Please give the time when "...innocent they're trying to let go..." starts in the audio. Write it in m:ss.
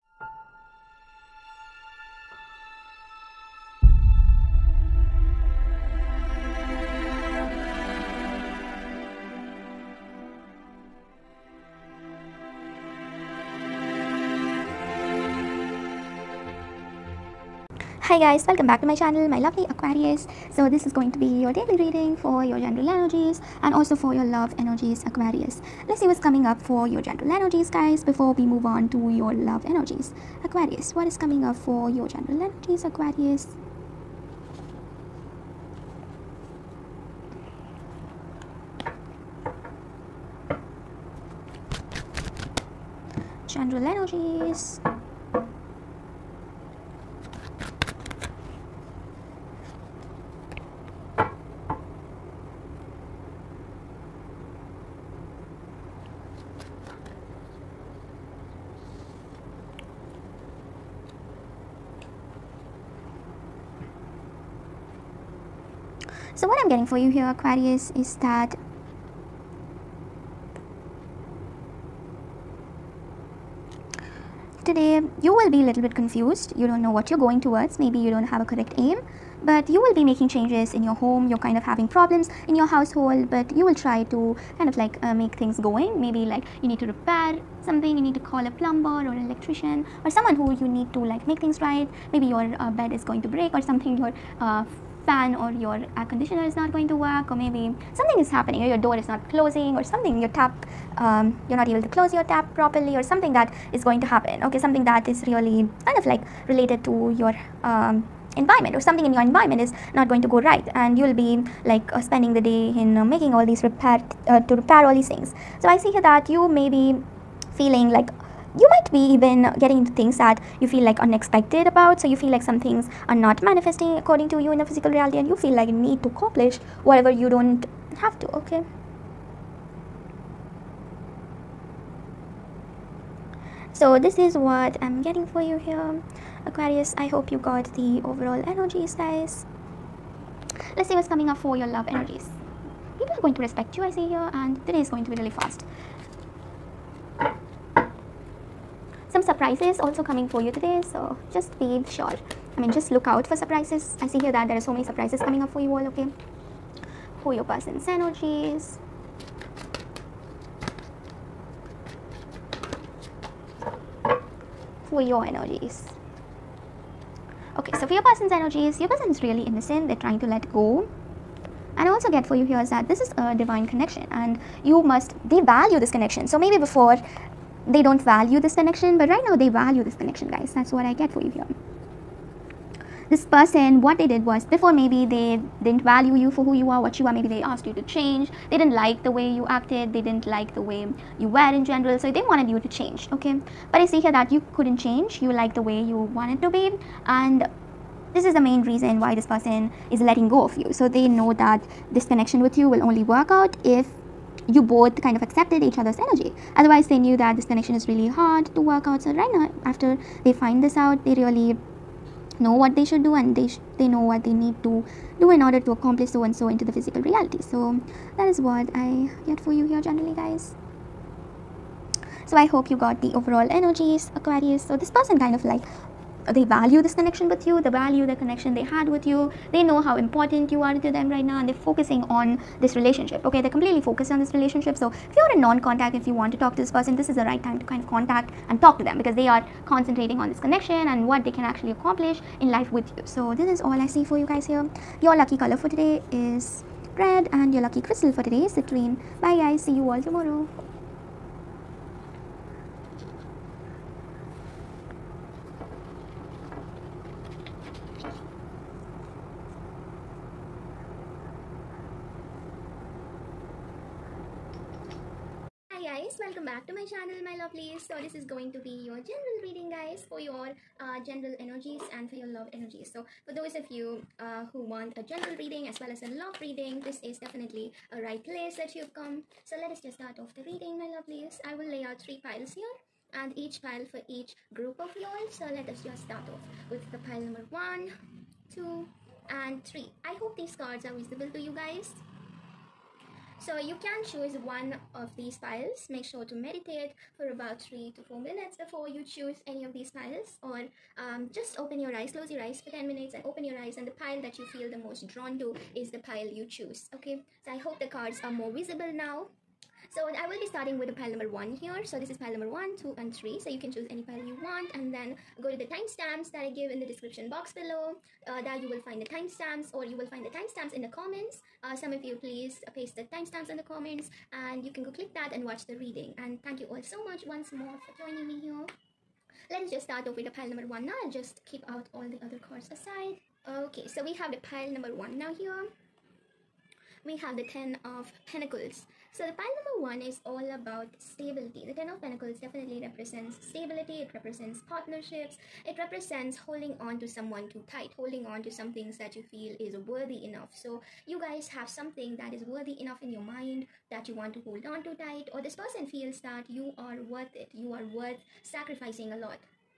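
2:49.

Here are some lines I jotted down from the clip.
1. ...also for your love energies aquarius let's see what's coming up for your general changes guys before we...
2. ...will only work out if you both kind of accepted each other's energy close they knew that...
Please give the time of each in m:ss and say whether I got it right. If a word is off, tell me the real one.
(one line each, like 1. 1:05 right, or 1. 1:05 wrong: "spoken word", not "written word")
1. 0:23 wrong: "energies", not "changes"
2. 3:22 wrong: "otherwise", not "close".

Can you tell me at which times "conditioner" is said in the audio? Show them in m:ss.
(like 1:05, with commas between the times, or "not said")
1:36.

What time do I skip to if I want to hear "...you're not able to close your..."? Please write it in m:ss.
1:41.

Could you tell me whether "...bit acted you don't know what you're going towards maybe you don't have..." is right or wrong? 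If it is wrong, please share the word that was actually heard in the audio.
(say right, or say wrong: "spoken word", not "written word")
wrong: "confused", not "acted".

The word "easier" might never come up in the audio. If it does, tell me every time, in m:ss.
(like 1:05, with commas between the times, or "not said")
not said.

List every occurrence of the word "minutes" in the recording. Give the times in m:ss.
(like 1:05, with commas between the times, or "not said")
4:58, 5:02.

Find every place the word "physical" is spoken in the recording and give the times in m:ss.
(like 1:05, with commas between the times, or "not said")
2:04, 3:36.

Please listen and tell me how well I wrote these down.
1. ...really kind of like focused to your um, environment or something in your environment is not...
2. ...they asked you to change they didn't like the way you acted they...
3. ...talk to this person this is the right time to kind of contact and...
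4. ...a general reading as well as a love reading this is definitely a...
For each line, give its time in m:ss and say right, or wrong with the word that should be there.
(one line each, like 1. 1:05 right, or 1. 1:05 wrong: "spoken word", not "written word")
1. 1:45 wrong: "related", not "focused"
2. 3:07 right
3. 3:56 right
4. 4:34 right.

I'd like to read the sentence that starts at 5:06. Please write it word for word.
Okay, I hope the cards are more visible now.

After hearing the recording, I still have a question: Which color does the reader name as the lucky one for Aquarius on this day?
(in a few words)
Red.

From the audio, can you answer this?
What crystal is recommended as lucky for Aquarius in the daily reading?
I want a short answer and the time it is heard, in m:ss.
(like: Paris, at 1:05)
Citrine, at 4:08.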